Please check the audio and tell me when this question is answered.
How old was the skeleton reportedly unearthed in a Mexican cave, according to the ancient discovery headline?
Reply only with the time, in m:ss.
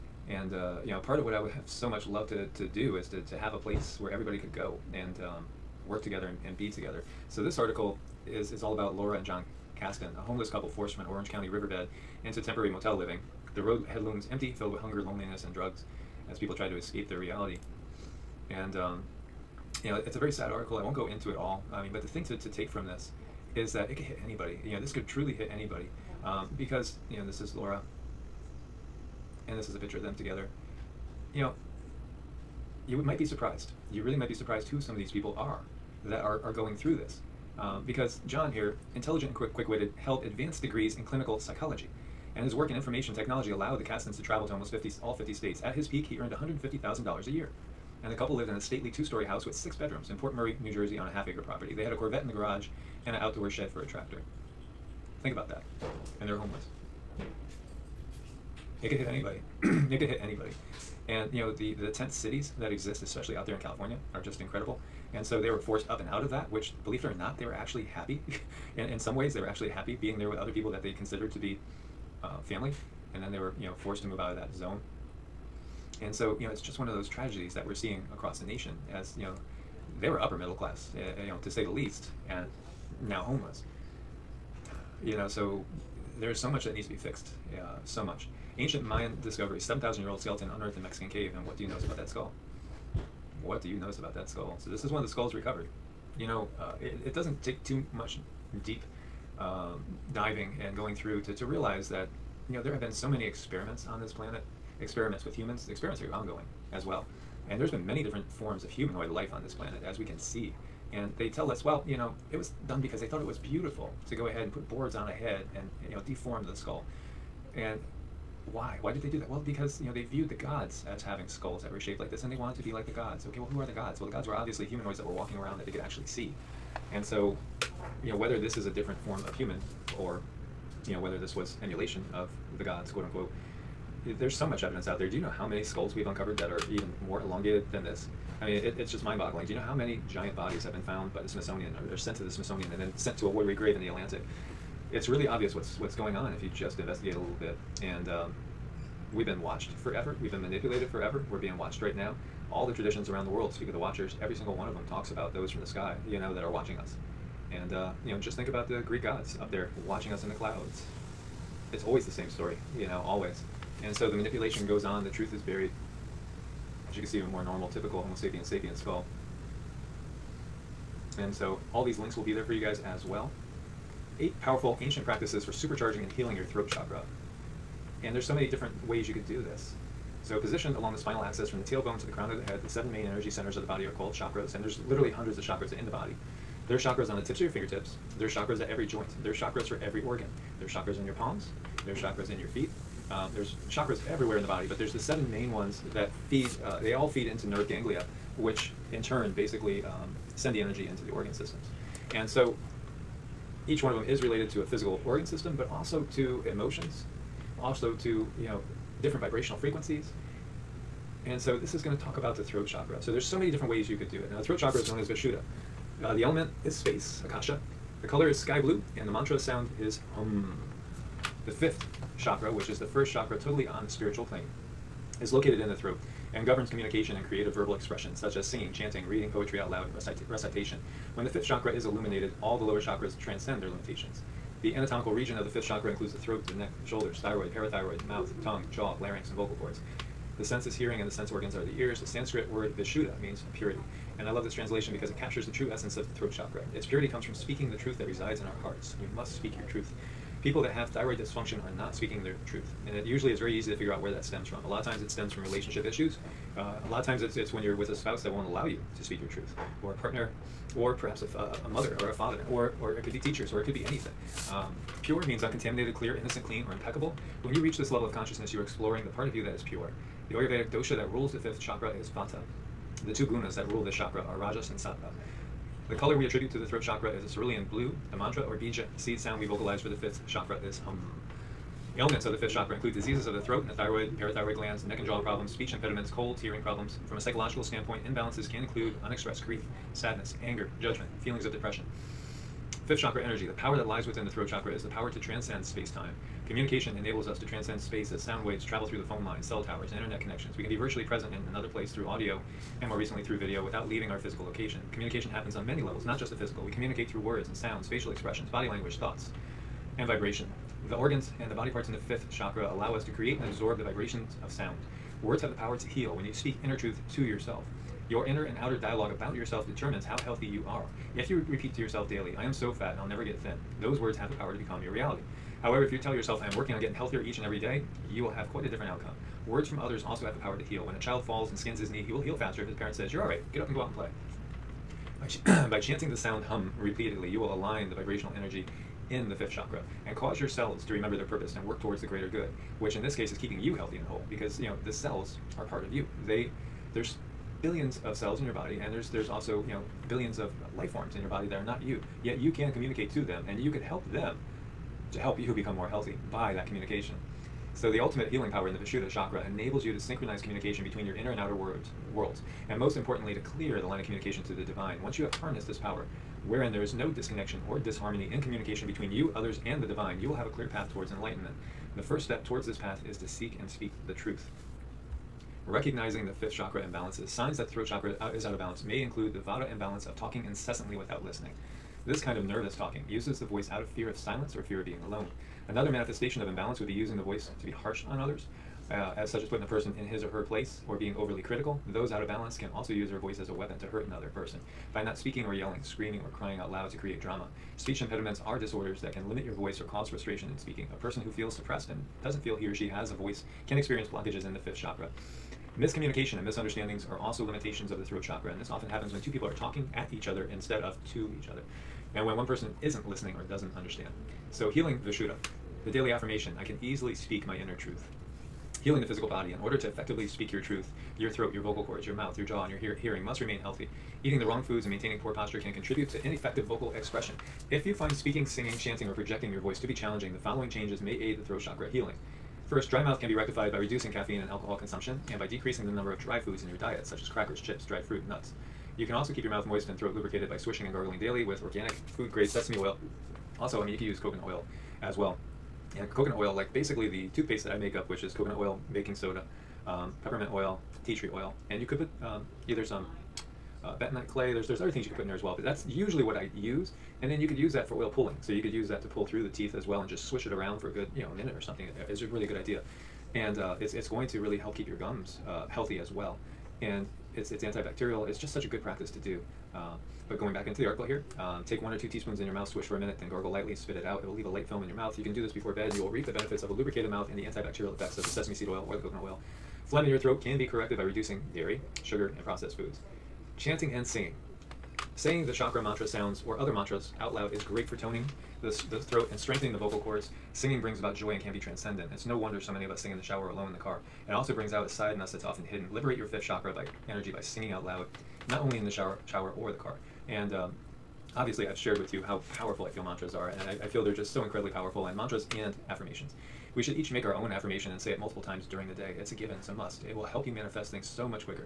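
1:29.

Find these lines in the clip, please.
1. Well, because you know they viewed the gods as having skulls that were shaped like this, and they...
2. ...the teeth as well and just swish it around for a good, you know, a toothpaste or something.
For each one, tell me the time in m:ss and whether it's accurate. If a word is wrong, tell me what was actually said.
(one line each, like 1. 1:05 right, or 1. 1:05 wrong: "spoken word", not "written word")
1. 1:59 right
2. 7:39 wrong: "minute", not "toothpaste".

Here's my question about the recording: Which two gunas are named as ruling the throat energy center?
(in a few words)
Rajas and Sattva.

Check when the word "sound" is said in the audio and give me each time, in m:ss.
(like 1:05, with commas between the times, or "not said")
3:39, 4:39, 4:58, 5:07, 5:14, 5:36, 8:06.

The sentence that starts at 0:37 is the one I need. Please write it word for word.
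Um, because John here, intelligent and quick, witted held advanced degrees in clinical psychology.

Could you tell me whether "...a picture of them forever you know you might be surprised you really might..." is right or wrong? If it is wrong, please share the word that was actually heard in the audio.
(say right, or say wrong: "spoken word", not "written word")
wrong: "together", not "forever".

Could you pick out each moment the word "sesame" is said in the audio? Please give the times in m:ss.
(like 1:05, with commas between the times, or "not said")
7:22, 7:58.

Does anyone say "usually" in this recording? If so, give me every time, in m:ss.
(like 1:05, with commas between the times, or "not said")
4:13, 7:35.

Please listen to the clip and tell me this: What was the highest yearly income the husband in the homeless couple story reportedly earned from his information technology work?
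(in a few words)
$150,000.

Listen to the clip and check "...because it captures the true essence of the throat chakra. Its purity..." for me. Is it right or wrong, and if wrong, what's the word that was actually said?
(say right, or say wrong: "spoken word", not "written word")
right.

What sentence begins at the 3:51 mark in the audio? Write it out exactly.
When the fifth chakra is illuminated, all the lower chakras transcend their limitations.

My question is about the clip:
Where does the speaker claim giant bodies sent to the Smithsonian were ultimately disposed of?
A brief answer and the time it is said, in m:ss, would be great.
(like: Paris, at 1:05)
the Atlantic, at 2:23.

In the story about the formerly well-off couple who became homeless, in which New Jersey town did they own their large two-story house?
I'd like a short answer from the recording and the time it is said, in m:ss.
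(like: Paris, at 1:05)
Port Murray, at 0:50.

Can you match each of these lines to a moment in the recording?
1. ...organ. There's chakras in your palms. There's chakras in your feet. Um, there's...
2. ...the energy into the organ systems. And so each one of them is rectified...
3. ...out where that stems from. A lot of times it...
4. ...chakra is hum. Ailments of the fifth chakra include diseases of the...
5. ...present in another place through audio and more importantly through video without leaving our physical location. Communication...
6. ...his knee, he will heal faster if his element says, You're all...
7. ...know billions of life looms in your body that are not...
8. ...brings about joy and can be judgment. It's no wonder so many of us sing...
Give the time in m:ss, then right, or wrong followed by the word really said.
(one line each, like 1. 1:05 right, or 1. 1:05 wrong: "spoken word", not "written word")
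1. 3:10 right
2. 3:20 wrong: "related", not "rectified"
3. 4:13 right
4. 4:40 right
5. 5:01 wrong: "recently", not "importantly"
6. 5:31 wrong: "parent", not "element"
7. 5:49 wrong: "forms", not "looms"
8. 8:10 wrong: "transcendent", not "judgment".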